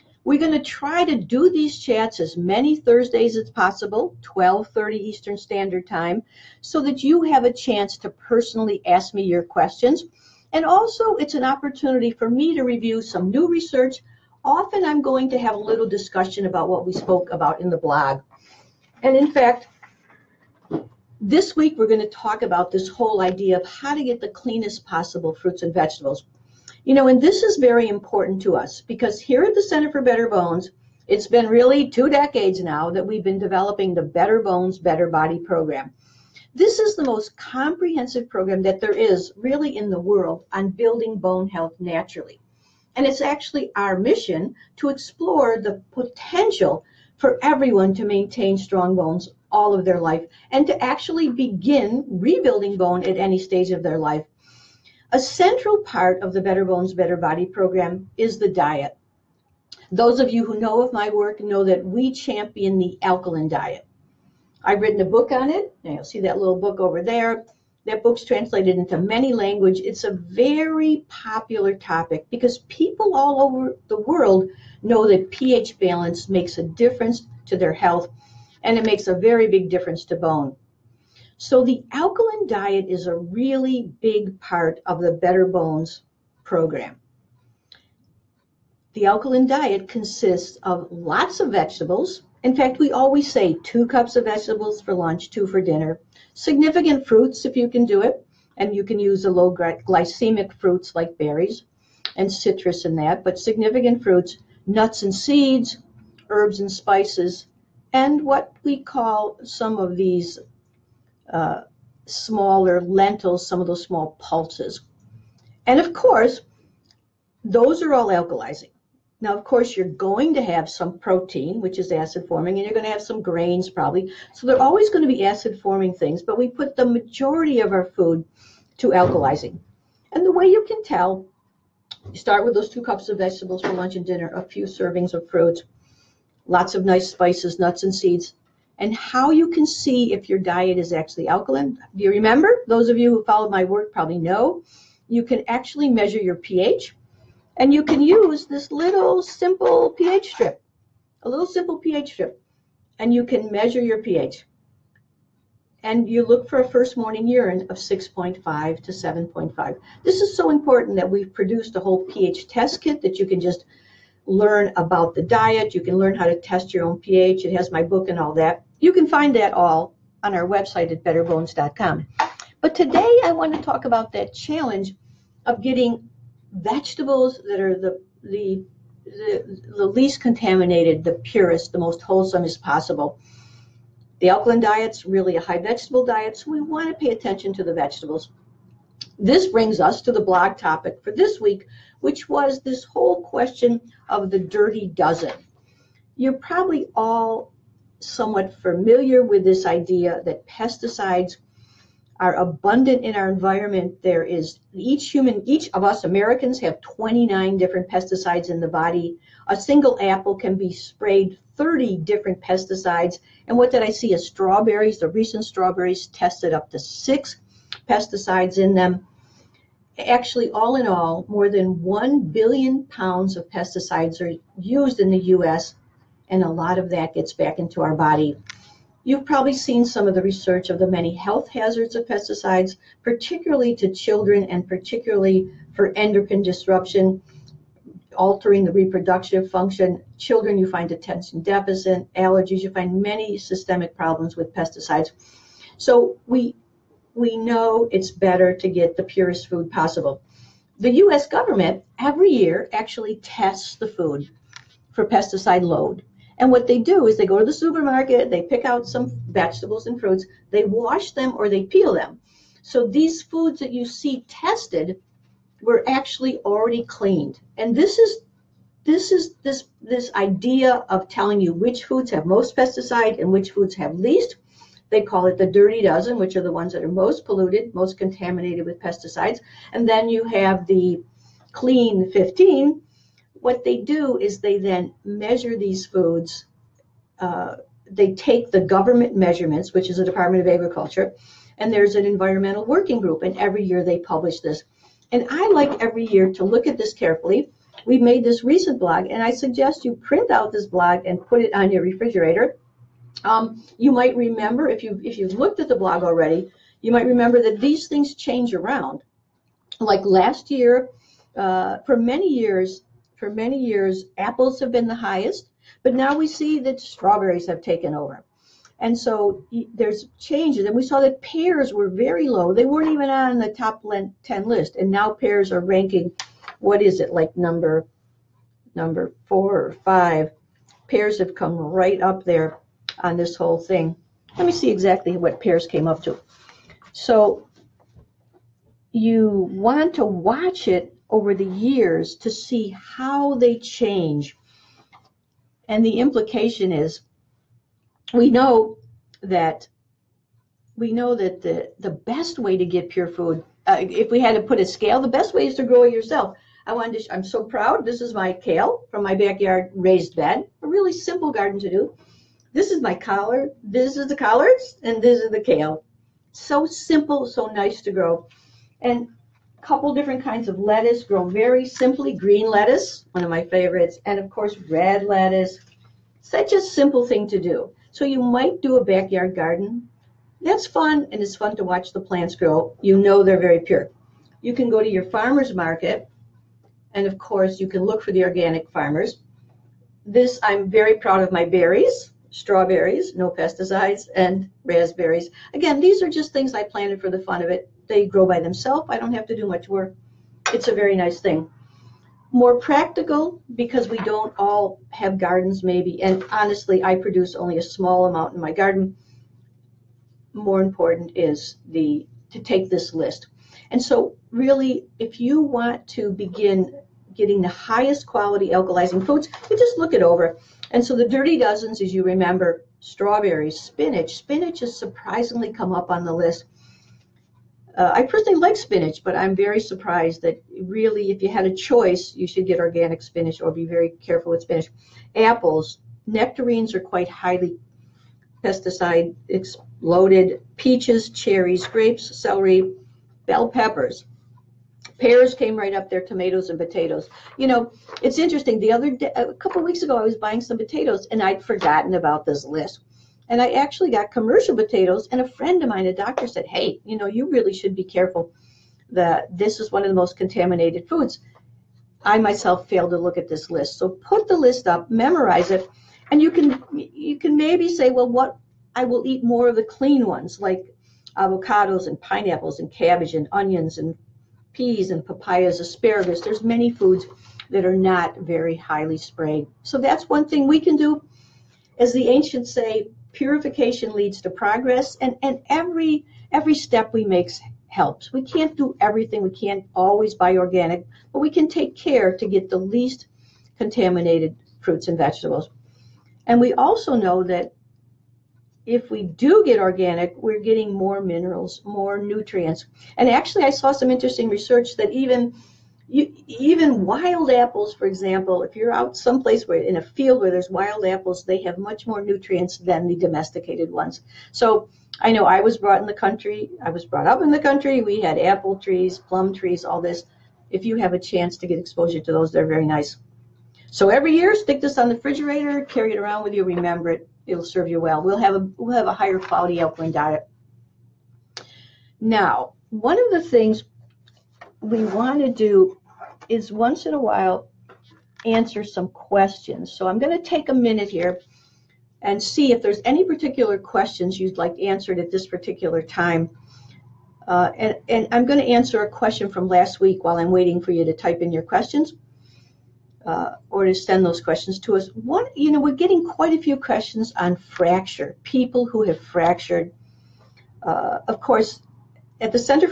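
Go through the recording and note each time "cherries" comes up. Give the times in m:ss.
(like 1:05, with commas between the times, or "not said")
7:21.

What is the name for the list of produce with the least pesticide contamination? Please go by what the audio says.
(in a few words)
clean 15.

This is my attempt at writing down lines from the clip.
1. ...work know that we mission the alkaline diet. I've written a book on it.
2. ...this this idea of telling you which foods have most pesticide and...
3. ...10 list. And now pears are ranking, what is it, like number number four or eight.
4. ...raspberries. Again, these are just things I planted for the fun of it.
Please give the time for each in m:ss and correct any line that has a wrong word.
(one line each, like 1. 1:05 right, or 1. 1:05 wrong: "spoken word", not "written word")
1. 1:01 wrong: "champion", not "mission"
2. 4:29 right
3. 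5:24 wrong: "five", not "eight"
4. 6:34 right.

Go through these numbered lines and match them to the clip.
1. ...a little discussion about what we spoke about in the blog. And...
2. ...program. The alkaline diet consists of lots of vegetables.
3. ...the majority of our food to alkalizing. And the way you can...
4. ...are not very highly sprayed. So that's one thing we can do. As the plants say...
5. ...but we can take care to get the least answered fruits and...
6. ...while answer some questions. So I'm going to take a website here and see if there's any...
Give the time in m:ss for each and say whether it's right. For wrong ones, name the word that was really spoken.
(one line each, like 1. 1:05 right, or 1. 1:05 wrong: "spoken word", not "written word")
1. 0:15 right
2. 1:26 right
3. 2:06 right
4. 7:57 wrong: "ancients", not "plants"
5. 8:11 wrong: "contaminated", not "answered"
6. 8:56 wrong: "minute", not "website".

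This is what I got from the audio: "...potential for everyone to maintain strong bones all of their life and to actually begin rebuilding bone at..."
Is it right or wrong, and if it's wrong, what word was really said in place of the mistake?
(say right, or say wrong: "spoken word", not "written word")
right.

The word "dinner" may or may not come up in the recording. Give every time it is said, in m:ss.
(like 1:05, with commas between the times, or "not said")
1:35, 2:14.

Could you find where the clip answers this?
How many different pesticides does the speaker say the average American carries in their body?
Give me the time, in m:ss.
3:26.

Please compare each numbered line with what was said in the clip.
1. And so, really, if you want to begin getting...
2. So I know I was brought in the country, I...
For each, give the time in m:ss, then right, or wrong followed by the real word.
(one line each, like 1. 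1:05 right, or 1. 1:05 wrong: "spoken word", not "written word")
1. 6:53 right
2. 8:34 right.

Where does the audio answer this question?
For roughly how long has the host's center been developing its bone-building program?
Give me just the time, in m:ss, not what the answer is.
0:31.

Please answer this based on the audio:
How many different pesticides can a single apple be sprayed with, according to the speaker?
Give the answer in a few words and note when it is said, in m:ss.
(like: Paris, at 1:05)
30, at 3:31.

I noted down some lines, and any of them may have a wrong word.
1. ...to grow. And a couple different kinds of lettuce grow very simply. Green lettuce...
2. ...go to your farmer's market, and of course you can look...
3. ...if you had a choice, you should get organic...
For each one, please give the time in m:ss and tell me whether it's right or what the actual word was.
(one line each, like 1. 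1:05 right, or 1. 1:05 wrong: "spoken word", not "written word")
1. 6:07 right
2. 6:24 right
3. 7:11 right.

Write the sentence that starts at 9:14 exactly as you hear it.
What you know, we're getting quite a few questions on fracture, people who have fractured.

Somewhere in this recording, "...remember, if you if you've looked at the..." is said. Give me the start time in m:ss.
5:04.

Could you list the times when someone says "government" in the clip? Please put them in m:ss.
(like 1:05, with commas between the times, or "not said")
4:11, 4:48.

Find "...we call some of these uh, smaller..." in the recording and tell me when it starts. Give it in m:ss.
1:48.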